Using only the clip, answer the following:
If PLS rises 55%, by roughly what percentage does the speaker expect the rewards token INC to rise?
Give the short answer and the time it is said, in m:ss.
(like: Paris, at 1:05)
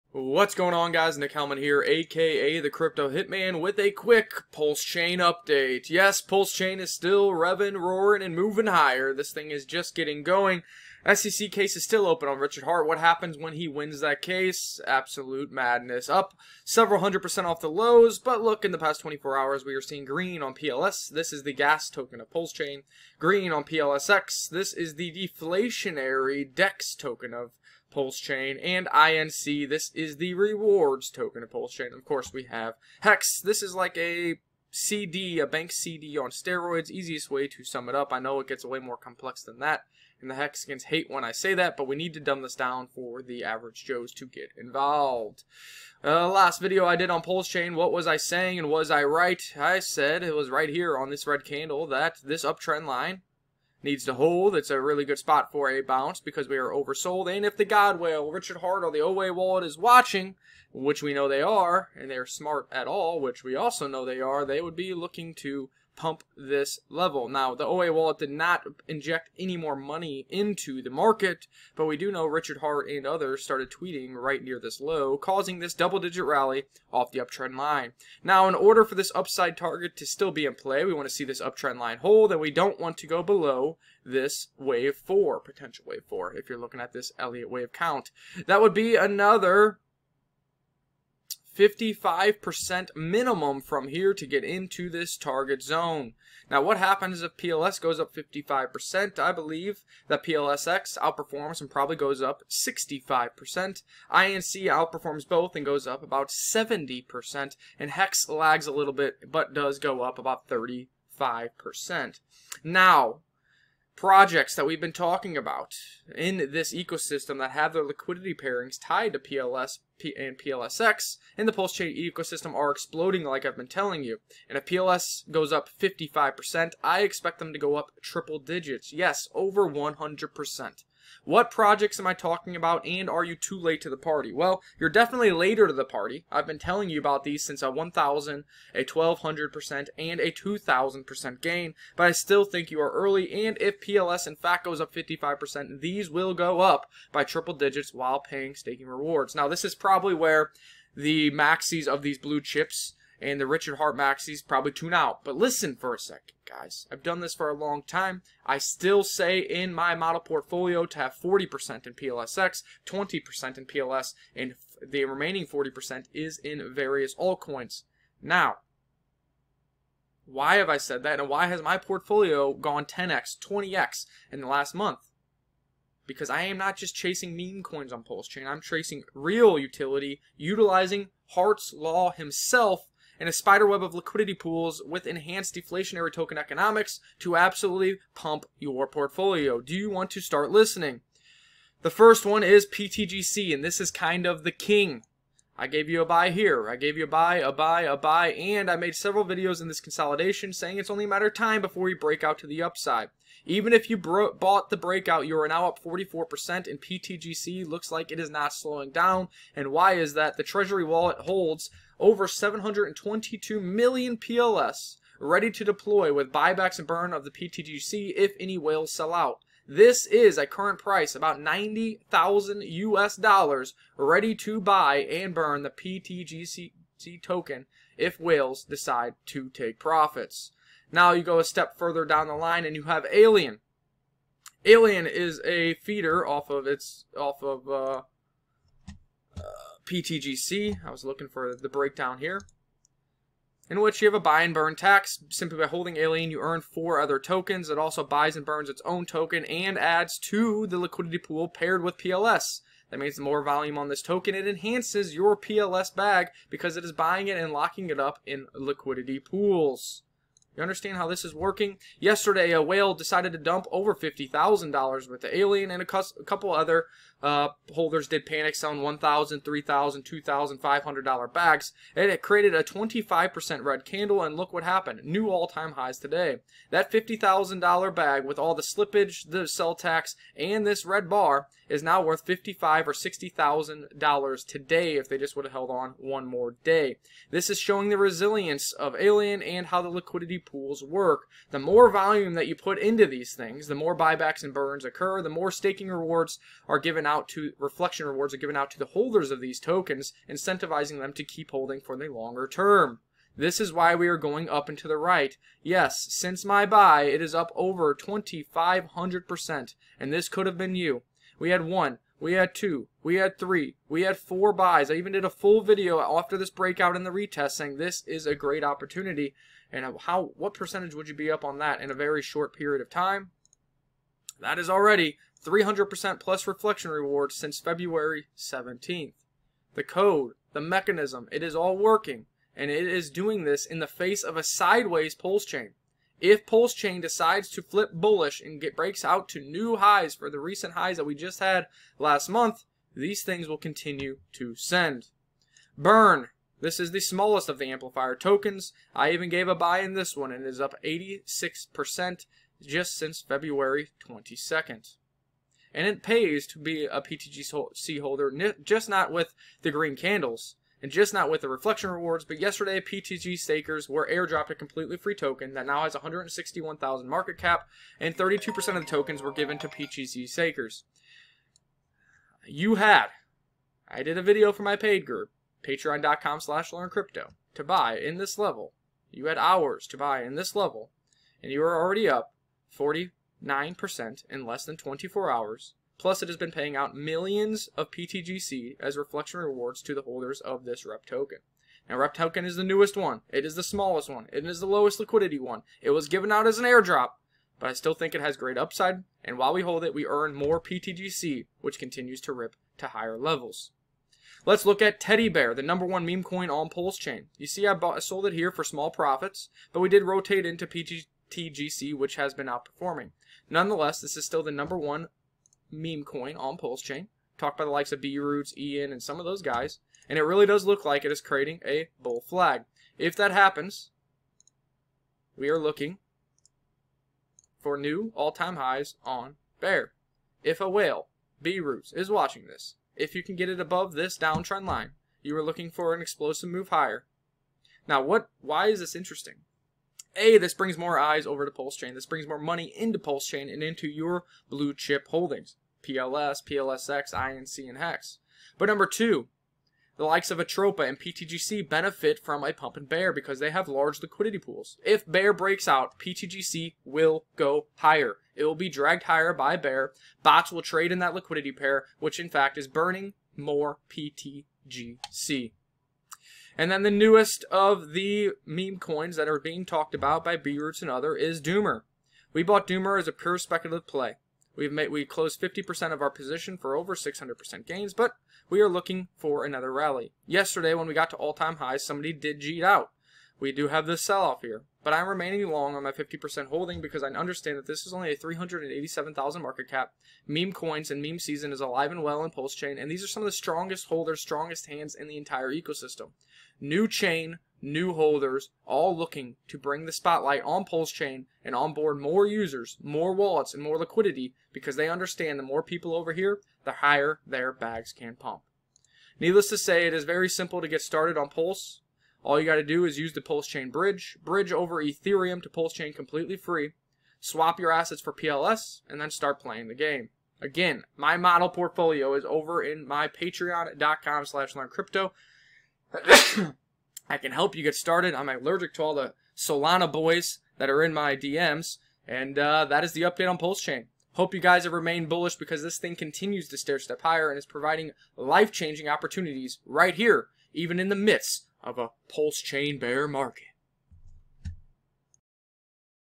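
70%, at 1:46.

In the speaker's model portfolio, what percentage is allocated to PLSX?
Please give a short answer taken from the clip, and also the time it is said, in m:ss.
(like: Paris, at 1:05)
40%, at 2:41.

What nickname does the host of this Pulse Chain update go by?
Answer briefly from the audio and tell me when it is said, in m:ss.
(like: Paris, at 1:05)
the Crypto Hitman, at 0:02.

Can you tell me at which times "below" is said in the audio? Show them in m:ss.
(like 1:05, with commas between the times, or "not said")
1:23.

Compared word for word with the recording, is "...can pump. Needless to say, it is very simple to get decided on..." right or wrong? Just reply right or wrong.
wrong.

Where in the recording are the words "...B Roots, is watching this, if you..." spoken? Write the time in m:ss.
7:11.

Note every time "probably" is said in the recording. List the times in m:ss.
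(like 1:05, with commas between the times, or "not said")
1:41, 2:29, 2:34.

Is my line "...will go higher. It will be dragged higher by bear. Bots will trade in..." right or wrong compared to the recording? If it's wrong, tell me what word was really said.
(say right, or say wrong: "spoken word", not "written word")
right.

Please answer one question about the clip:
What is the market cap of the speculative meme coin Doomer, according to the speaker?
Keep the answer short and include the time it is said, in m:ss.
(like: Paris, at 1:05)
387,000, at 8:08.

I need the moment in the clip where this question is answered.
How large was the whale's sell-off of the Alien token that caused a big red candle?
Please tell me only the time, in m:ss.
4:23.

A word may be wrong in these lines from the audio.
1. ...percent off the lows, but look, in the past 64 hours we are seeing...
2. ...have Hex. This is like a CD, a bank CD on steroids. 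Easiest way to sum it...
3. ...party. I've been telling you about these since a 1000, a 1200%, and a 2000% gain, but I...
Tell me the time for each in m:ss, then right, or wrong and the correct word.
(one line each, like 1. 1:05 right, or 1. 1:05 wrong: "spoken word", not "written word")
1. 0:17 wrong: "24", not "64"
2. 0:32 right
3. 2:15 right.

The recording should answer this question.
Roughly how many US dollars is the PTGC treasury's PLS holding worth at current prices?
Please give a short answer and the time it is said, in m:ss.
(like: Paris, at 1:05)
$90,000, at 3:41.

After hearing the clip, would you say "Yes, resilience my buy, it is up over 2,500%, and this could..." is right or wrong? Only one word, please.
wrong.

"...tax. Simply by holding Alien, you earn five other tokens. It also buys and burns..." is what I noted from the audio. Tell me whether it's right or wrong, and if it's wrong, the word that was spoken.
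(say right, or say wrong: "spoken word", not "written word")
wrong: "four", not "five".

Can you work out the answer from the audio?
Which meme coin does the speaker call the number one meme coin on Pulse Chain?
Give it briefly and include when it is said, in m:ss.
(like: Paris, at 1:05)
Teddy Bear, at 6:44.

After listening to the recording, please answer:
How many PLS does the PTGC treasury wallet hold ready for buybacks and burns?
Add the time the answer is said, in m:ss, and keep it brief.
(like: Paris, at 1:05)
722 million, at 3:32.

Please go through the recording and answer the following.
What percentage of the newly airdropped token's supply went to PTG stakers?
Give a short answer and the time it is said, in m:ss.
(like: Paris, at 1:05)
32%, at 6:08.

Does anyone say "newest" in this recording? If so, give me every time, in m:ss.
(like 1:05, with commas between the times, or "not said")
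6:32, 7:46.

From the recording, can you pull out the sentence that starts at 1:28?
That would be another 55% minimum from here to get into this target zone.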